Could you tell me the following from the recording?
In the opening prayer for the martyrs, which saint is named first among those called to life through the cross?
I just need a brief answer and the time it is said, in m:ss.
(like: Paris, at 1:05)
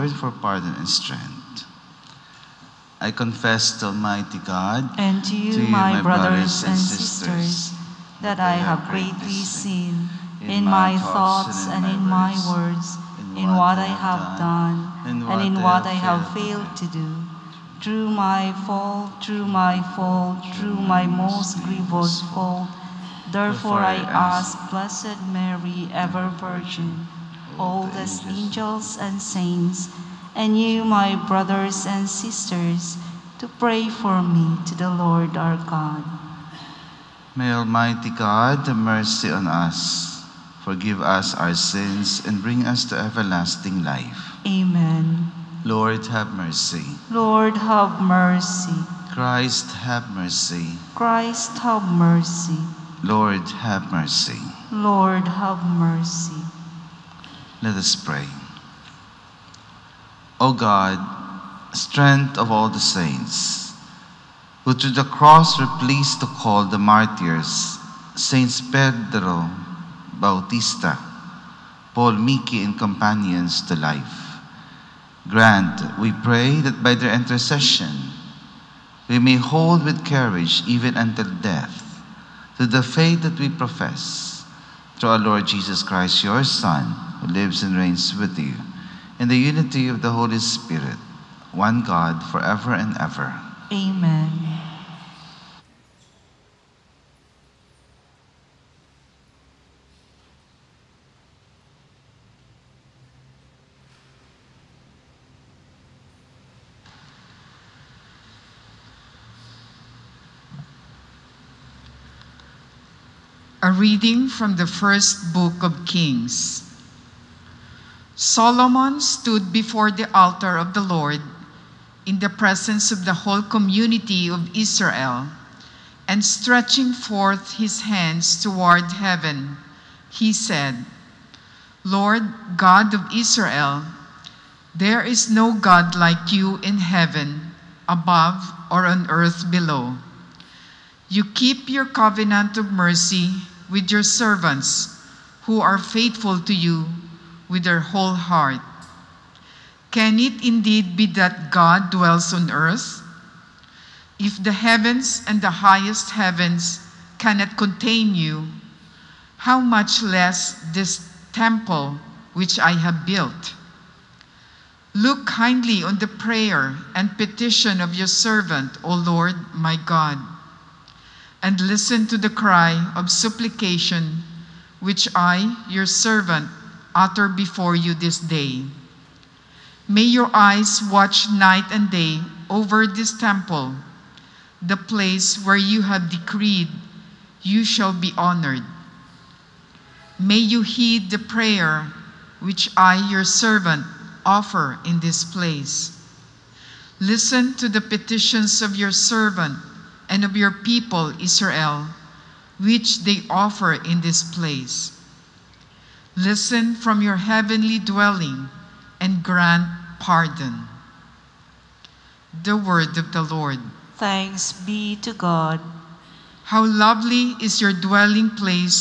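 Pedro, at 1:08.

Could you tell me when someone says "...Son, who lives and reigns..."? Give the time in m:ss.
1:26.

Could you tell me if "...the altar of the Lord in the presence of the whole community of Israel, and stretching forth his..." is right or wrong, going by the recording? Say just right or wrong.
right.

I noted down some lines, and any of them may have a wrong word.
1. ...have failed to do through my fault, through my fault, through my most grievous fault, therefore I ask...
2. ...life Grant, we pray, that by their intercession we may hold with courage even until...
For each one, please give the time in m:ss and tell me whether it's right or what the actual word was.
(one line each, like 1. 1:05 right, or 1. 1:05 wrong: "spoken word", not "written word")
1. 0:15 right
2. 1:13 right.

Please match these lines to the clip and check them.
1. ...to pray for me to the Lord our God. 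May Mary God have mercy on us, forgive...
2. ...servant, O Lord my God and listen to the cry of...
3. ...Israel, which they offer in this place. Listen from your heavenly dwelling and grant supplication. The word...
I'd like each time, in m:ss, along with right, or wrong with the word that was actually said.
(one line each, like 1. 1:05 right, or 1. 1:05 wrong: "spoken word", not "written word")
1. 0:33 wrong: "Almighty", not "Mary"
2. 2:48 right
3. 3:21 wrong: "pardon", not "supplication".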